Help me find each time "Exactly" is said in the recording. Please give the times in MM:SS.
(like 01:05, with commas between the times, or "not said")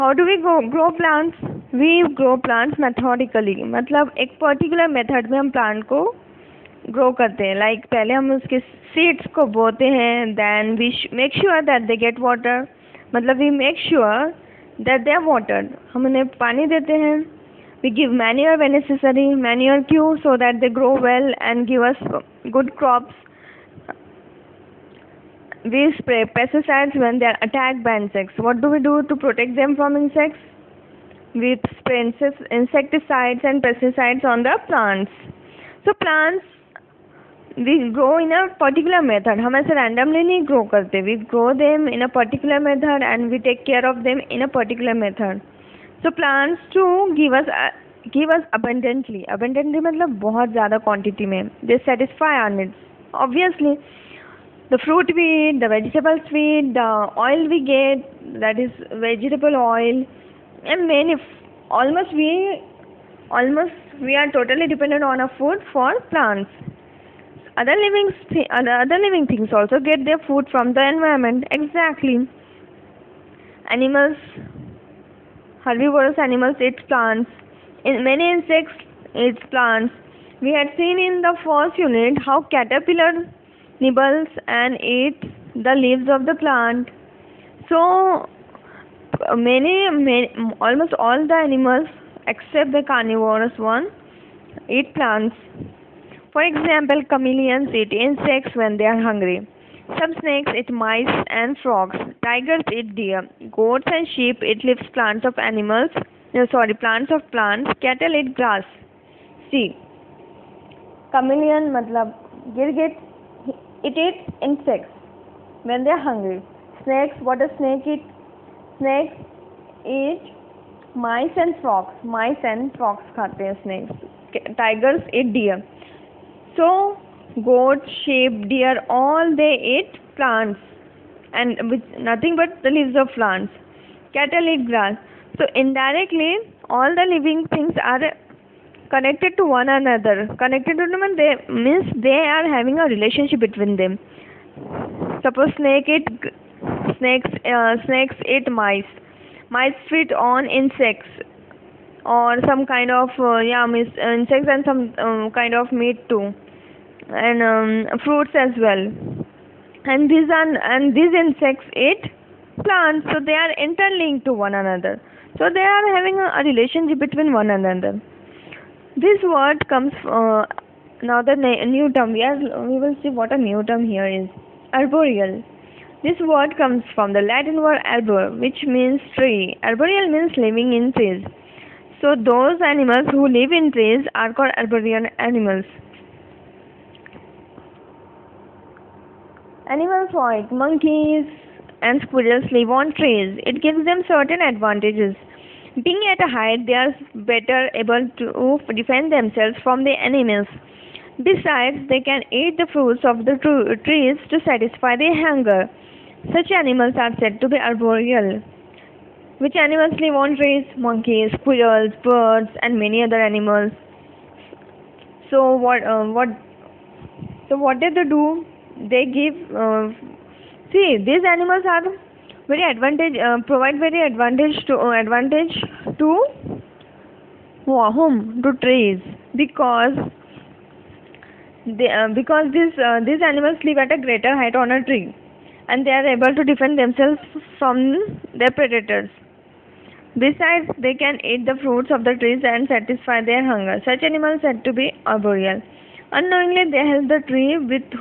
01:11.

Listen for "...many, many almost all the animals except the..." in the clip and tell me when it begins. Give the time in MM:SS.
01:29.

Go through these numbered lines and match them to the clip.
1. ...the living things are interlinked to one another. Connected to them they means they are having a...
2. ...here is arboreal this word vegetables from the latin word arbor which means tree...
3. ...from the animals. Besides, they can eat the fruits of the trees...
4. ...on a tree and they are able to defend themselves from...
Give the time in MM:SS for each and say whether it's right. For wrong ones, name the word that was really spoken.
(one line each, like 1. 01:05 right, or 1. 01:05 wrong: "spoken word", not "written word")
1. 02:16 wrong: "connected", not "interlinked"
2. 02:53 wrong: "comes", not "vegetables"
3. 03:19 right
4. 03:54 right.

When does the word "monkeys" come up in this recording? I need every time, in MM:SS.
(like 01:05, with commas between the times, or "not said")
03:10, 03:30.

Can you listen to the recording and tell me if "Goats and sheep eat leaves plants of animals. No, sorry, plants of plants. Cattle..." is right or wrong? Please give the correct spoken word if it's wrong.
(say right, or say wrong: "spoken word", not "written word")
right.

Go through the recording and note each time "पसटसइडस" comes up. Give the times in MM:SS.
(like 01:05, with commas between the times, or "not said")
00:26, 00:33.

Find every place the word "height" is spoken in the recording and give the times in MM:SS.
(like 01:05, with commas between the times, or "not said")
03:16, 03:54.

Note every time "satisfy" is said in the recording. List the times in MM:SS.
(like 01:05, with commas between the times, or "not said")
00:51, 03:24, 04:02.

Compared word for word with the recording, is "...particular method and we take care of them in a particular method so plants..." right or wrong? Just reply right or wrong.
right.